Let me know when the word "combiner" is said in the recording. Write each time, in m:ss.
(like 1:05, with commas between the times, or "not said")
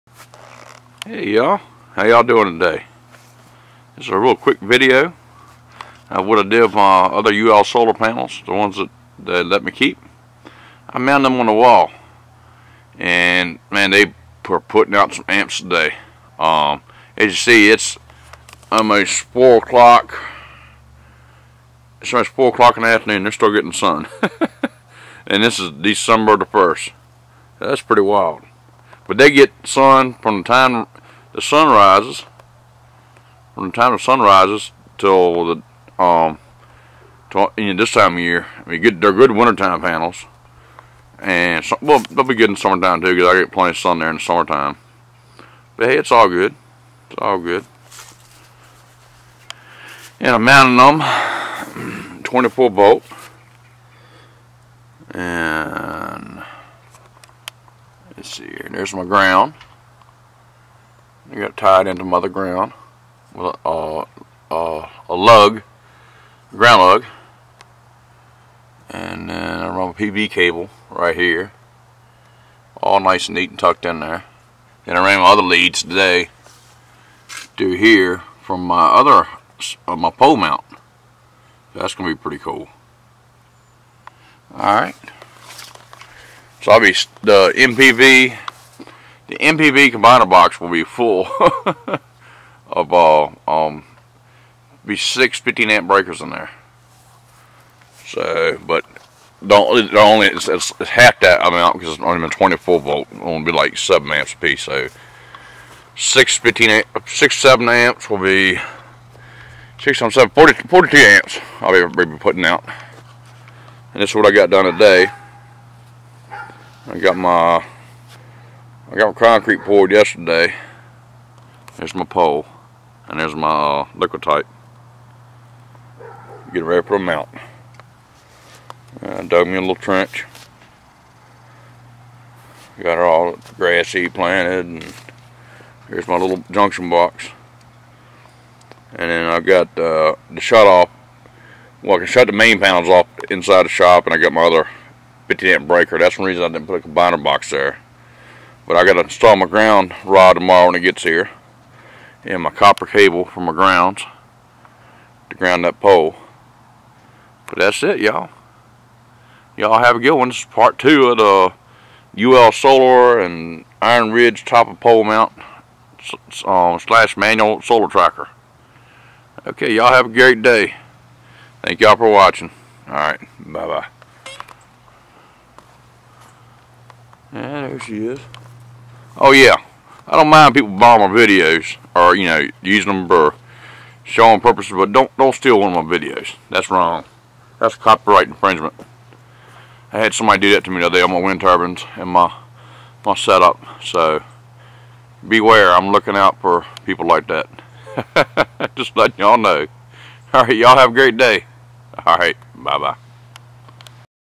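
1:29, 2:26.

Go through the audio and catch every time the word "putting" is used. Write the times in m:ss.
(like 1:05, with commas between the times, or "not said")
0:14, 1:52.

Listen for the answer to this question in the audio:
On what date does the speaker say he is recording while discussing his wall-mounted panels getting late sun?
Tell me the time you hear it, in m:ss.
0:25.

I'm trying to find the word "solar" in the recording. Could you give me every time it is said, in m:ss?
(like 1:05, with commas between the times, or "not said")
0:07, 2:42, 2:47.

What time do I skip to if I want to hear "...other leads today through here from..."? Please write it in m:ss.
1:15.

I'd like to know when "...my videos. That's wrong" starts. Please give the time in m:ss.
3:05.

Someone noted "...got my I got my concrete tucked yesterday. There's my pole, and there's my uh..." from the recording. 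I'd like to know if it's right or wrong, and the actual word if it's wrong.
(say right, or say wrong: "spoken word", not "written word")
wrong: "poured", not "tucked".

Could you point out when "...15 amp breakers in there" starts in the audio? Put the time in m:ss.
1:35.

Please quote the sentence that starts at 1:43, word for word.
It'll be like seven amps a piece.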